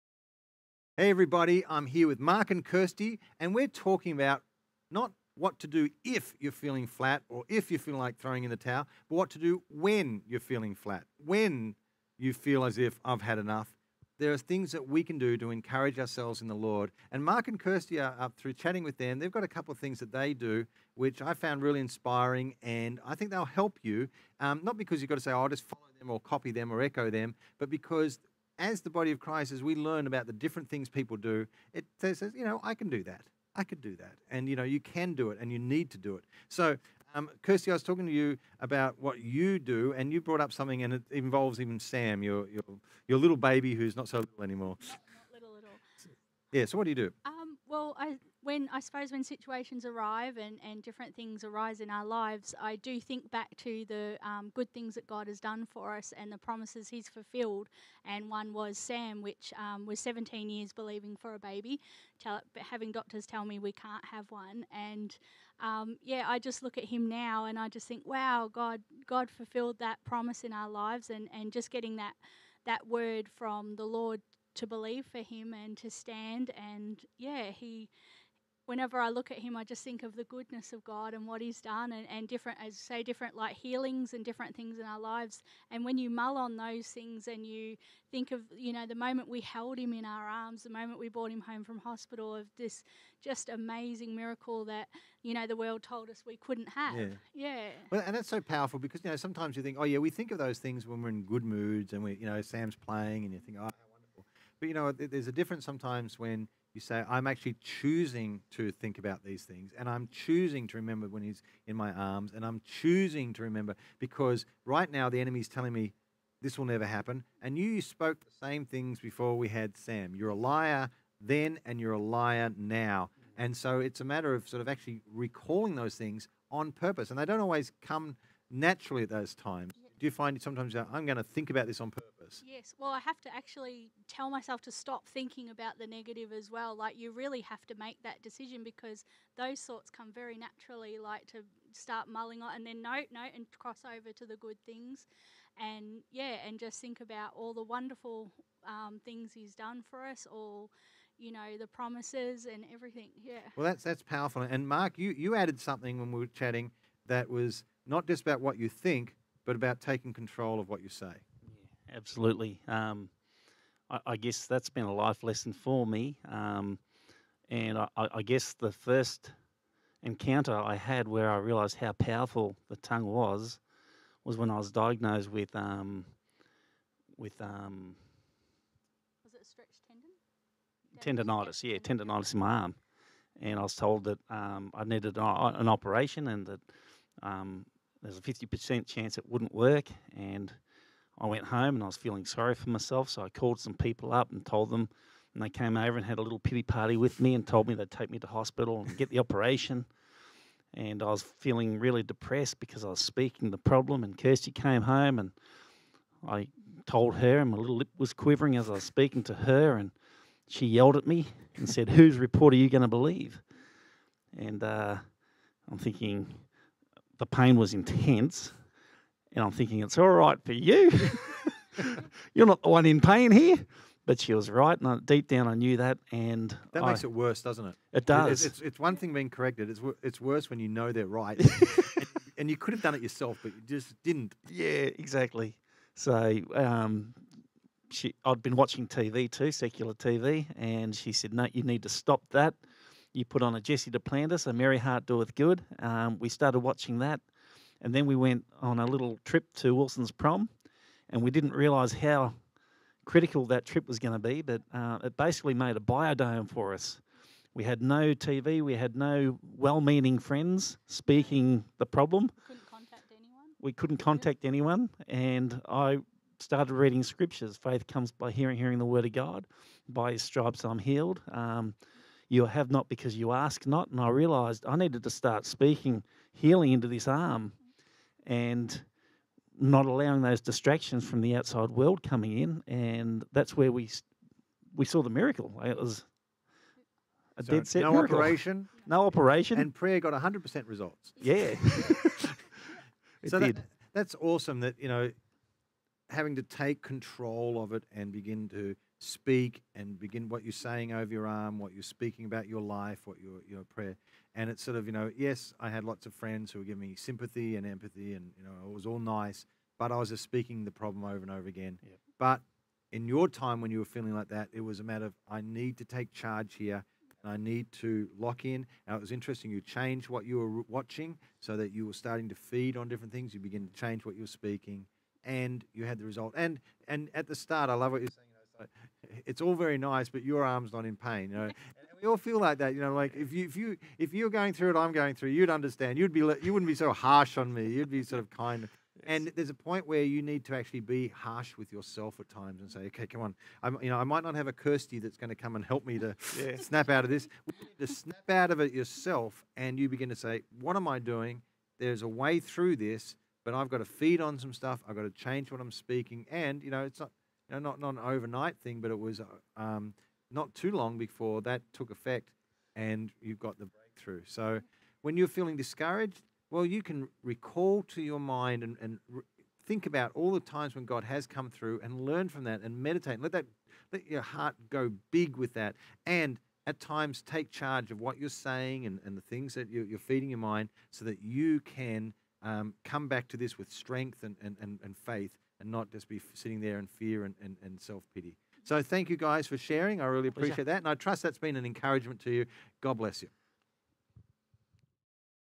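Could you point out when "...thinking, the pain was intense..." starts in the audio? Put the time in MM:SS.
03:35.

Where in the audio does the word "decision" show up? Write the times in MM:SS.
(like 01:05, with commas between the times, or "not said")
02:18.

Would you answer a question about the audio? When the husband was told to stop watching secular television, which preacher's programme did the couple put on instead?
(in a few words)
Jesse Duplantis.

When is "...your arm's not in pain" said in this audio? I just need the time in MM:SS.
05:30.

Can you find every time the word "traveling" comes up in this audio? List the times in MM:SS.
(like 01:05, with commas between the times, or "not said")
not said.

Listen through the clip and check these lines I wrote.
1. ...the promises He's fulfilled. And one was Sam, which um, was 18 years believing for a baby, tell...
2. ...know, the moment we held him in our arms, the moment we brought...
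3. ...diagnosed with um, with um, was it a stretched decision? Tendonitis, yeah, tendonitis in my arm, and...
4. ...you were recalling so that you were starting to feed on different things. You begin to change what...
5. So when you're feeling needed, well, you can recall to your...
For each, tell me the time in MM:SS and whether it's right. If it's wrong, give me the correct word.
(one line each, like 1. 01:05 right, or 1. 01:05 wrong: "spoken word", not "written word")
1. 00:56 wrong: "17", not "18"
2. 01:28 right
3. 02:54 wrong: "tendon", not "decision"
4. 05:20 wrong: "watching", not "recalling"
5. 06:04 wrong: "discouraged", not "needed".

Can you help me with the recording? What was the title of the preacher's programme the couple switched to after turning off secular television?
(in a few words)
A Merry Heart Doeth Good.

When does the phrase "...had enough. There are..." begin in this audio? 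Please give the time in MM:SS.
00:13.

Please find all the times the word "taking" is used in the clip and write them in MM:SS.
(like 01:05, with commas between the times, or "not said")
02:39.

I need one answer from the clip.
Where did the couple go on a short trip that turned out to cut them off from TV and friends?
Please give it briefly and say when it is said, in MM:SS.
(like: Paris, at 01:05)
Wilson's Prom, at 04:09.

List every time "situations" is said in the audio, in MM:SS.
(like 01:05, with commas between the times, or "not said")
00:49.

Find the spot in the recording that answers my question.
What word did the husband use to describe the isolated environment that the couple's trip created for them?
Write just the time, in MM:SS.
04:15.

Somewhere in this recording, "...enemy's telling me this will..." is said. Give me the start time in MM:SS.
01:55.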